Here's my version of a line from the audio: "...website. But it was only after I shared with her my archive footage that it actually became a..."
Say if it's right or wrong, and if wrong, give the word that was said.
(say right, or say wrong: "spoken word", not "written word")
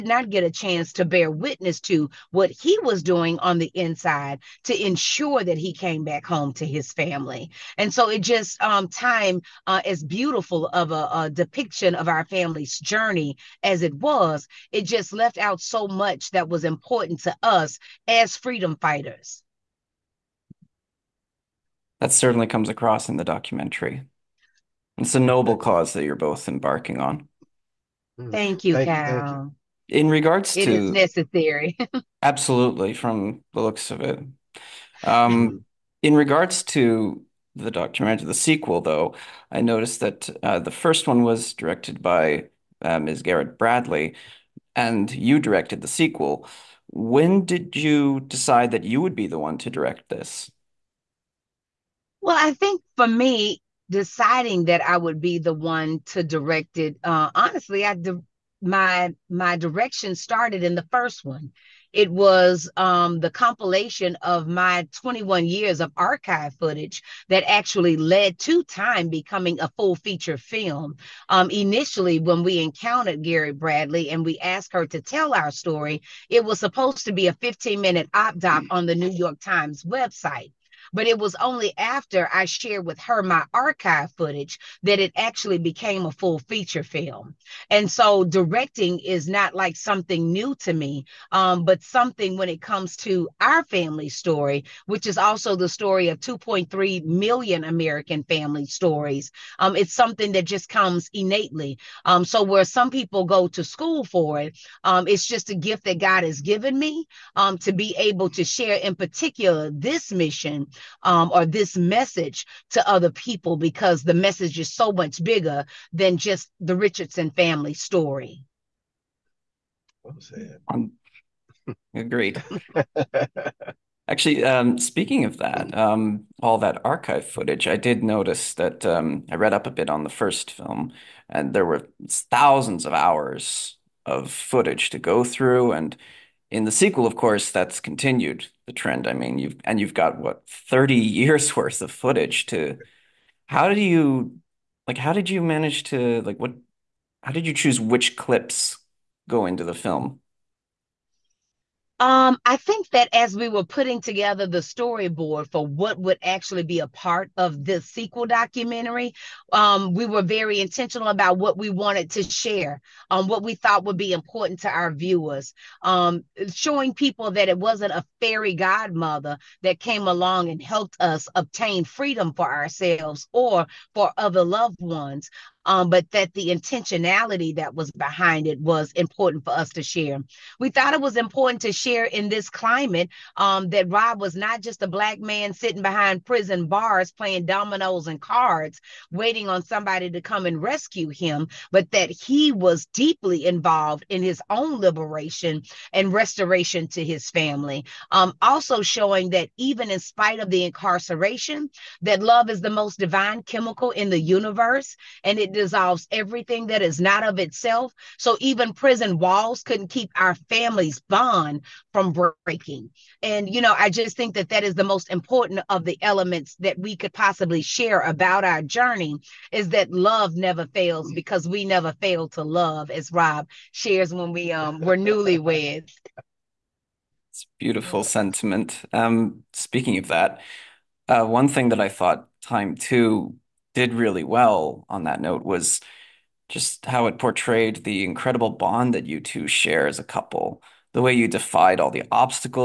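right.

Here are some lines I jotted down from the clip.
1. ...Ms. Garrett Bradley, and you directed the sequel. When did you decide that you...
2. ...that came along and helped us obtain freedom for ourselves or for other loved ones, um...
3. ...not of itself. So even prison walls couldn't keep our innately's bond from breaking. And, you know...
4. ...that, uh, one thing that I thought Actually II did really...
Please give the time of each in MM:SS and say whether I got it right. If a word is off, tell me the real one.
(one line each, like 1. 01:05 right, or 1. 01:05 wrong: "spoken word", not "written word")
1. 00:42 right
2. 02:49 right
3. 03:26 wrong: "family", not "innately"
4. 03:50 wrong: "Time", not "Actually".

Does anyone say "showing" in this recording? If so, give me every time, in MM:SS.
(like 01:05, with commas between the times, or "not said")
02:46, 03:18.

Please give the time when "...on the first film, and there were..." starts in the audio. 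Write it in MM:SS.
02:09.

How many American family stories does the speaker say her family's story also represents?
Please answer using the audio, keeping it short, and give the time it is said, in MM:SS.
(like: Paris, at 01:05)
2.3 million, at 01:36.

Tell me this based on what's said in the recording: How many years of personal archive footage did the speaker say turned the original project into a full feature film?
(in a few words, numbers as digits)
21.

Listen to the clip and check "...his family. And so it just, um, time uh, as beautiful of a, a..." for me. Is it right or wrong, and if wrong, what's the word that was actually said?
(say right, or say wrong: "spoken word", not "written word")
right.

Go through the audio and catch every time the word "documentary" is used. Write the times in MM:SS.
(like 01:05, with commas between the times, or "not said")
00:23, 00:37, 02:38.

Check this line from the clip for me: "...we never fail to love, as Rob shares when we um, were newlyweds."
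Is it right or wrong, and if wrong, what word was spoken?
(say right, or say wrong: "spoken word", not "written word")
right.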